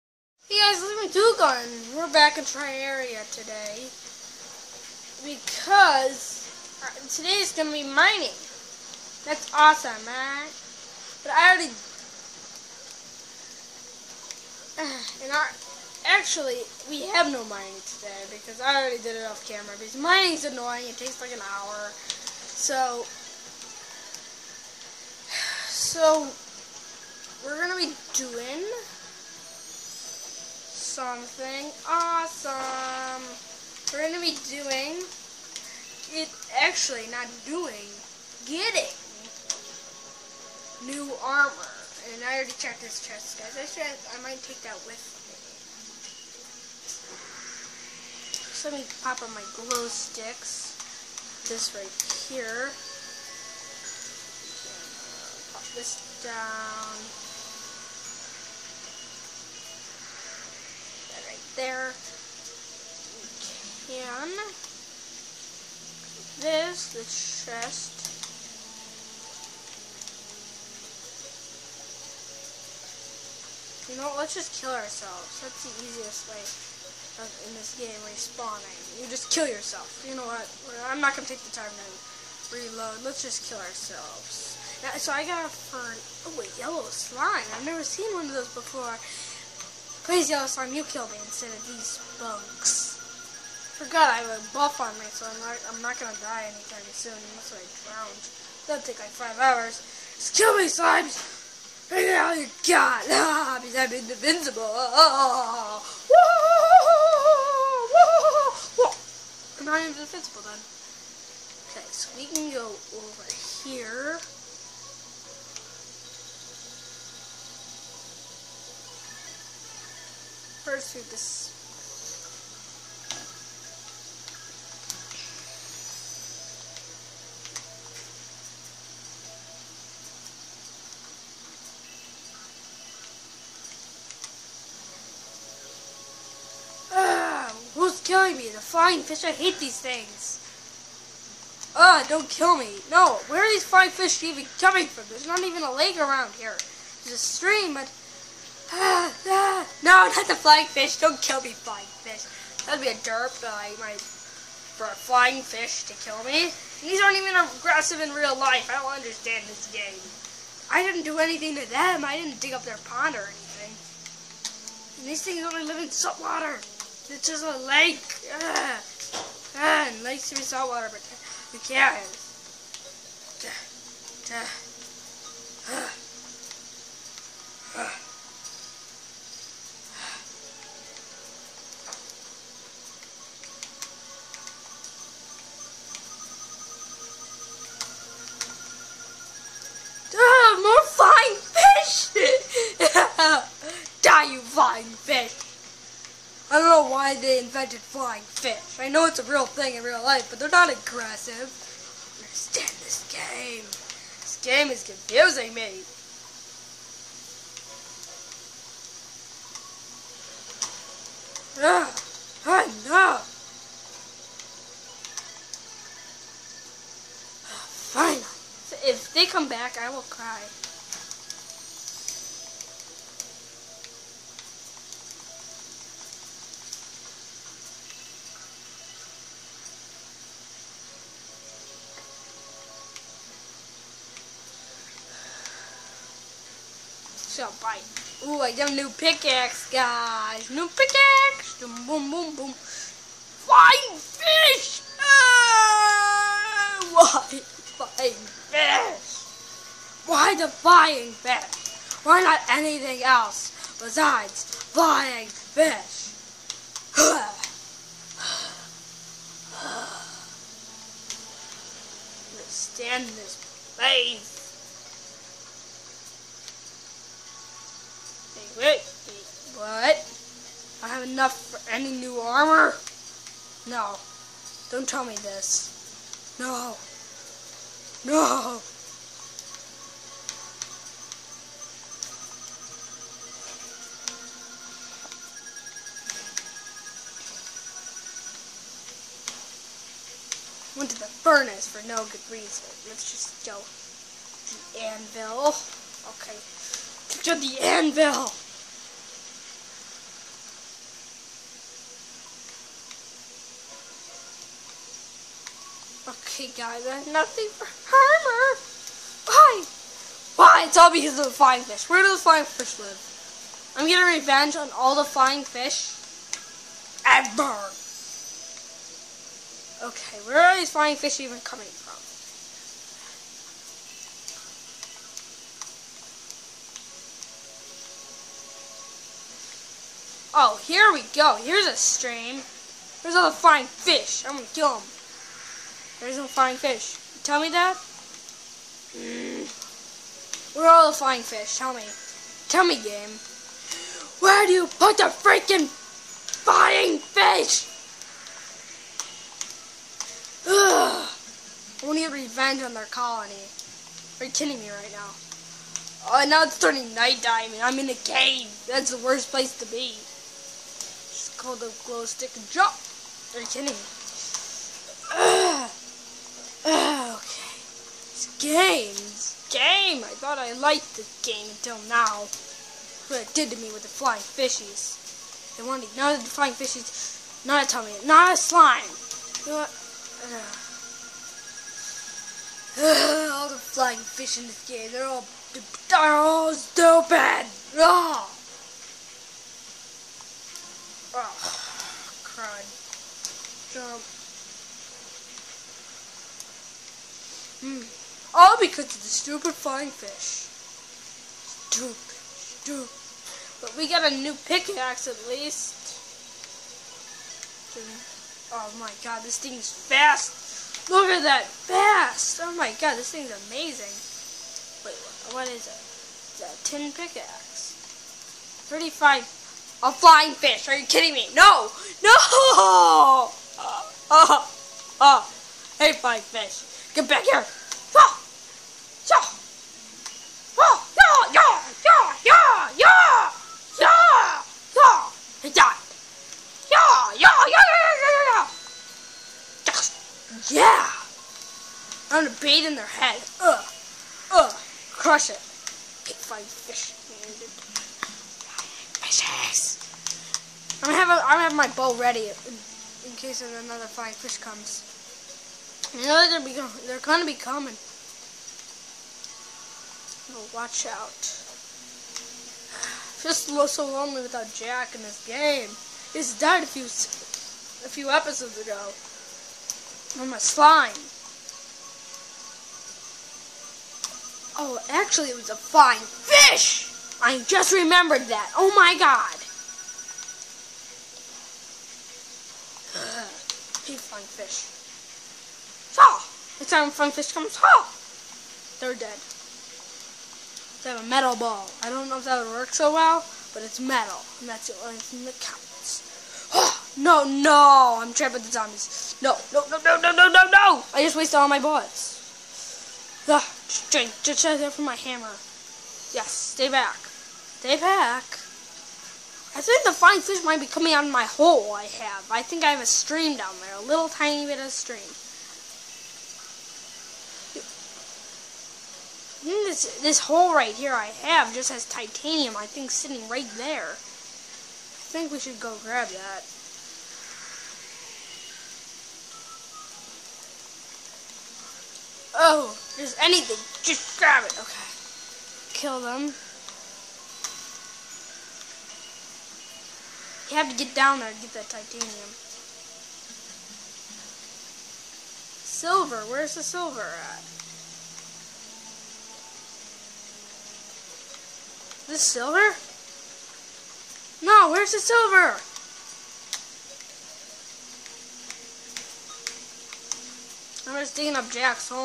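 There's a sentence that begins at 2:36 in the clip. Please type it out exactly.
These aren't even aggressive in real life.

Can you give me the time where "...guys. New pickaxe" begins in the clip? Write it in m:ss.
3:59.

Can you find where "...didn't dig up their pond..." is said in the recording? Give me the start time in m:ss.
2:42.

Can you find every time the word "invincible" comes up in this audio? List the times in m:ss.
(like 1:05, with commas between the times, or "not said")
1:43, 1:49.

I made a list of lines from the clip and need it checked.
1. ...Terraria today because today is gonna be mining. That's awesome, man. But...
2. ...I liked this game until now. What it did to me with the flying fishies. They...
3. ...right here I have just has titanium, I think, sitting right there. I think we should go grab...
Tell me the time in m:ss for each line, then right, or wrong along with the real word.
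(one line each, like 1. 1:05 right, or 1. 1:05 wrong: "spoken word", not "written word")
1. 0:02 right
2. 6:10 right
3. 8:40 right.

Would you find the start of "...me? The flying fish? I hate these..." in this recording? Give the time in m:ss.
2:18.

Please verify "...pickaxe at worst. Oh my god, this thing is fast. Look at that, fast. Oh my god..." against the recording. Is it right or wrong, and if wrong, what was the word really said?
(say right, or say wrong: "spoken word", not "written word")
wrong: "least", not "worst".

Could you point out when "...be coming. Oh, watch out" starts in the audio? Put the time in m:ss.
7:37.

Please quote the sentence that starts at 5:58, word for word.
That's the worst place to be called the glow stick drop.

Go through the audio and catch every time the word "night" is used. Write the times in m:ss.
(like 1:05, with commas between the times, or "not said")
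5:56.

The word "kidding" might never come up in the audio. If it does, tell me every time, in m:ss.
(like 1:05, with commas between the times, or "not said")
5:54, 6:03, 7:00.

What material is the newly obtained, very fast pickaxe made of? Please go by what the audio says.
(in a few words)
Tin.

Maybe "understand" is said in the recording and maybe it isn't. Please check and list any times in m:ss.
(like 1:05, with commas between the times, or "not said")
2:38, 3:22.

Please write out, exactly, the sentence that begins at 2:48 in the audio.
Ah, ah and lakes live in salt water, but who cares?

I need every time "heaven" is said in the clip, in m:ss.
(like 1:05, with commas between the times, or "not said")
not said.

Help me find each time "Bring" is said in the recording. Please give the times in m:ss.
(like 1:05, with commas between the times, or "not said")
1:41.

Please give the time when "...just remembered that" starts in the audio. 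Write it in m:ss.
7:57.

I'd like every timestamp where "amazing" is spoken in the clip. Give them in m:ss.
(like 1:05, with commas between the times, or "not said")
6:53.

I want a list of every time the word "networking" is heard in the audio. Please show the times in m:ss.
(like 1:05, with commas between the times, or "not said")
not said.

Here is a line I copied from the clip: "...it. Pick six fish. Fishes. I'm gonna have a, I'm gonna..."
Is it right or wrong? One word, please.
wrong.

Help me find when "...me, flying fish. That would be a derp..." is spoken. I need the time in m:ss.
2:31.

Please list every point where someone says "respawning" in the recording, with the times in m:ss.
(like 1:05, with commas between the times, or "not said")
1:18.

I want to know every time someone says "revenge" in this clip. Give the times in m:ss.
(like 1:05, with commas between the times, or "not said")
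5:14, 5:52.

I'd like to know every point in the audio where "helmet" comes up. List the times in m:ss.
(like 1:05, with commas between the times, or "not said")
not said.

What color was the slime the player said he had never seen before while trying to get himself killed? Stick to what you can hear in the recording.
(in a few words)
Yellow.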